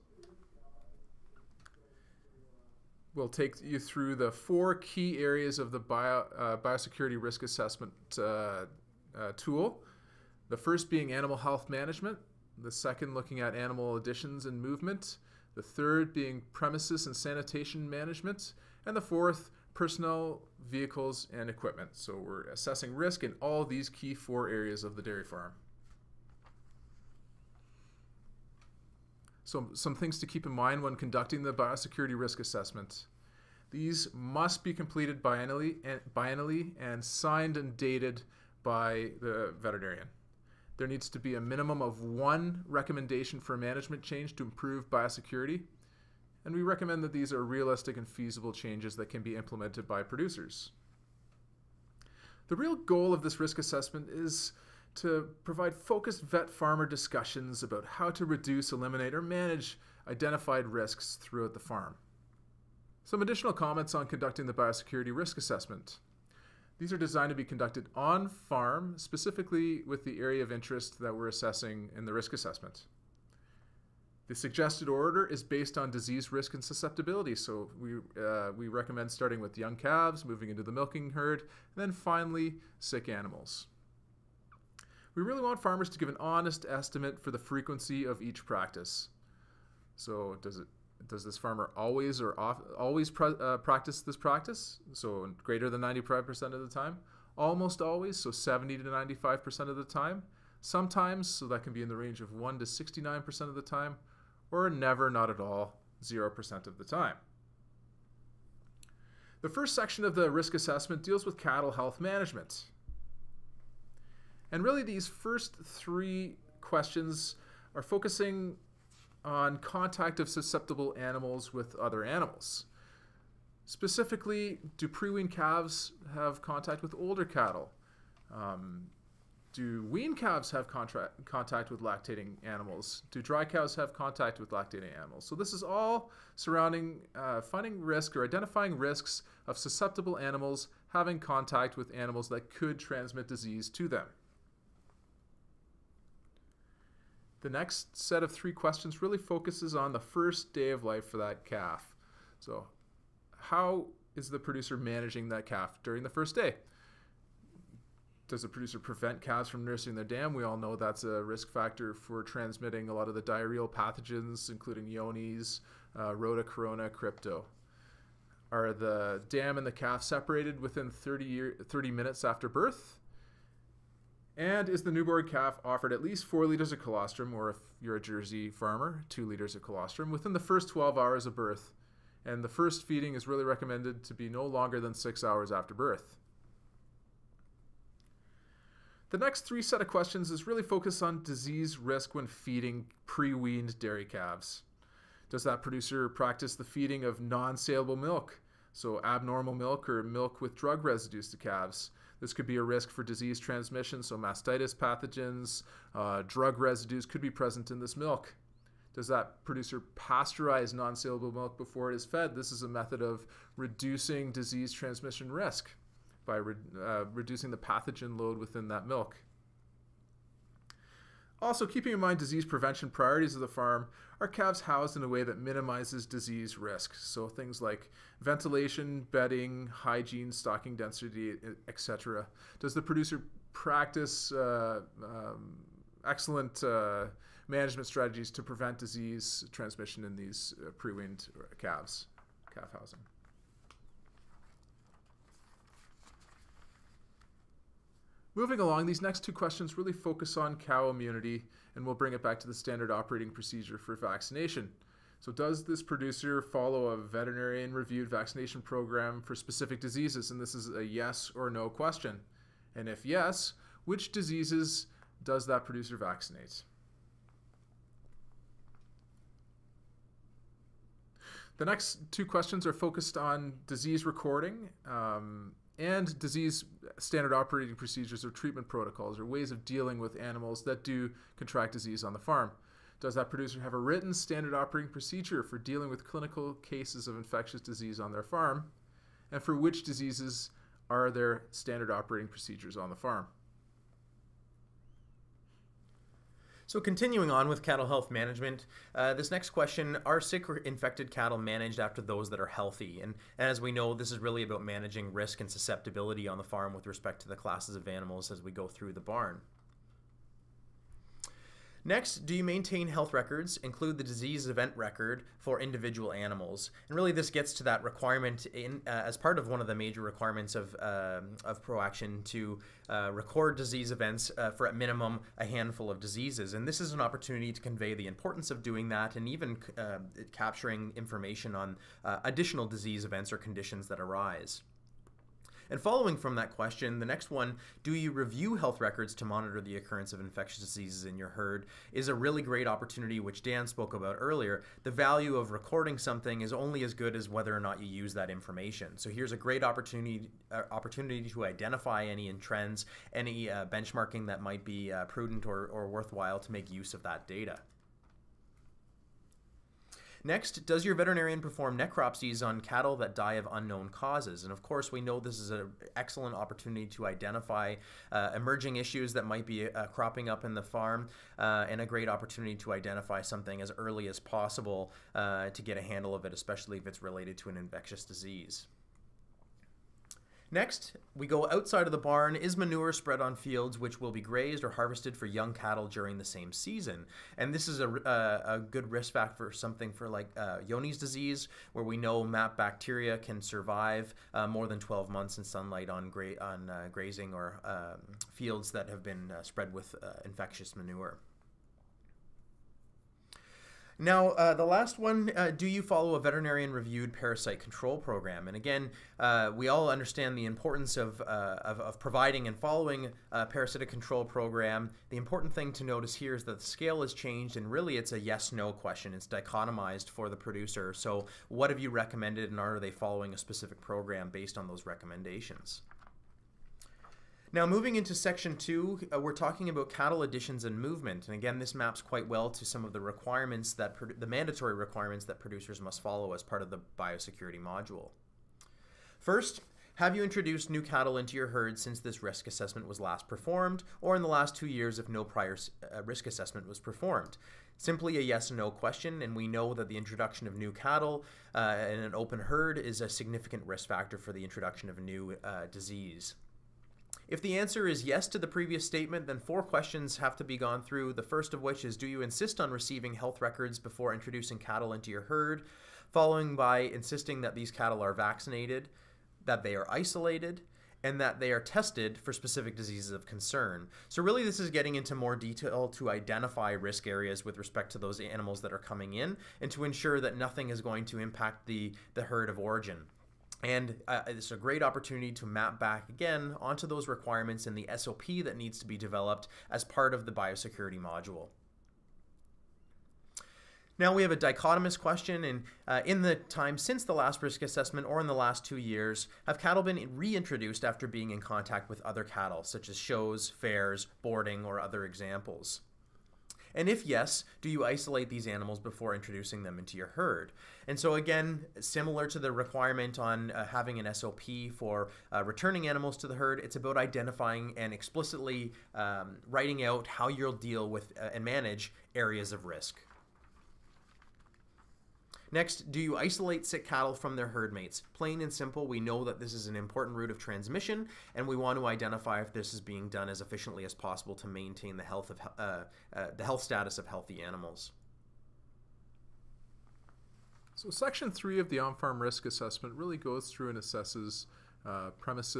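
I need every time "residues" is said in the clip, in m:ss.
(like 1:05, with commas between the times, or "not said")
3:20, 3:26.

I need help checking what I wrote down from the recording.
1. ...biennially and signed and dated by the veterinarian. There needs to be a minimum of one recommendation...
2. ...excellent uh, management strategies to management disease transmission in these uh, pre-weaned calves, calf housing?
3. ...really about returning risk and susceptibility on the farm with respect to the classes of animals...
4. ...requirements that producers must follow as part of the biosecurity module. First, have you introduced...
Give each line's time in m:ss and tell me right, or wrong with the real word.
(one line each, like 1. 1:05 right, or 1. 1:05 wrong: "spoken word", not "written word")
1. 0:36 right
2. 3:56 wrong: "prevent", not "management"
3. 5:04 wrong: "managing", not "returning"
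4. 7:14 right.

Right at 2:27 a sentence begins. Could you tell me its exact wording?
The next set of three questions really focuses on the first day of life for that calf.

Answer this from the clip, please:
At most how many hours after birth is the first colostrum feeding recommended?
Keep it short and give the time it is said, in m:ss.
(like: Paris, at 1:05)
6 hours, at 3:04.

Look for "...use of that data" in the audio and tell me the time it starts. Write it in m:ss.
5:56.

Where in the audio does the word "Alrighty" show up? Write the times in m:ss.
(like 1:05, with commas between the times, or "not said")
not said.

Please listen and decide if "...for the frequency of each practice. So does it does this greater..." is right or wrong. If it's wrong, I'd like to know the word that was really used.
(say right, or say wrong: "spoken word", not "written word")
wrong: "farmer", not "greater".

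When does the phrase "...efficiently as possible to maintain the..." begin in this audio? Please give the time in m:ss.
8:53.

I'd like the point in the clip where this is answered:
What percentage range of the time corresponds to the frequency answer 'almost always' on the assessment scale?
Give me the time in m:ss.
1:38.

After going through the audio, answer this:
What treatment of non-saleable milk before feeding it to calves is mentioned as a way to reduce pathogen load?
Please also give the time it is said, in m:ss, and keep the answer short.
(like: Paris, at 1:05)
Pasteurize, at 3:29.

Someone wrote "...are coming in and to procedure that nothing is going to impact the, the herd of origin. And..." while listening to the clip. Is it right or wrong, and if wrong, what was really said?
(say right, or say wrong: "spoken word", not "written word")
wrong: "ensure", not "procedure".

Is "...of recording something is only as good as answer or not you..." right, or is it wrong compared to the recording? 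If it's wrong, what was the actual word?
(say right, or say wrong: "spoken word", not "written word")
wrong: "whether", not "answer".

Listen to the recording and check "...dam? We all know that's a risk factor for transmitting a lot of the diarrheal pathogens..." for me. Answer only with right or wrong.
right.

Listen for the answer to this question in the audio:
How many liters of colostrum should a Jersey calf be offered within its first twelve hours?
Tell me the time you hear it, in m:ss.
2:59.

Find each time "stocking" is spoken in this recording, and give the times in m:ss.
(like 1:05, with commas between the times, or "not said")
3:50.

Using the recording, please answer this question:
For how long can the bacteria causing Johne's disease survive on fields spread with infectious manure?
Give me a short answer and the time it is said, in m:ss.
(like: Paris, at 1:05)
More than 12 months, at 6:34.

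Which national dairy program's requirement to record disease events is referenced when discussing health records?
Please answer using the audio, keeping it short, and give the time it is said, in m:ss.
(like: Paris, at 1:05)
ProAction, at 5:21.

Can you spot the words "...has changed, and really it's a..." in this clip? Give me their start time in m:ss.
6:57.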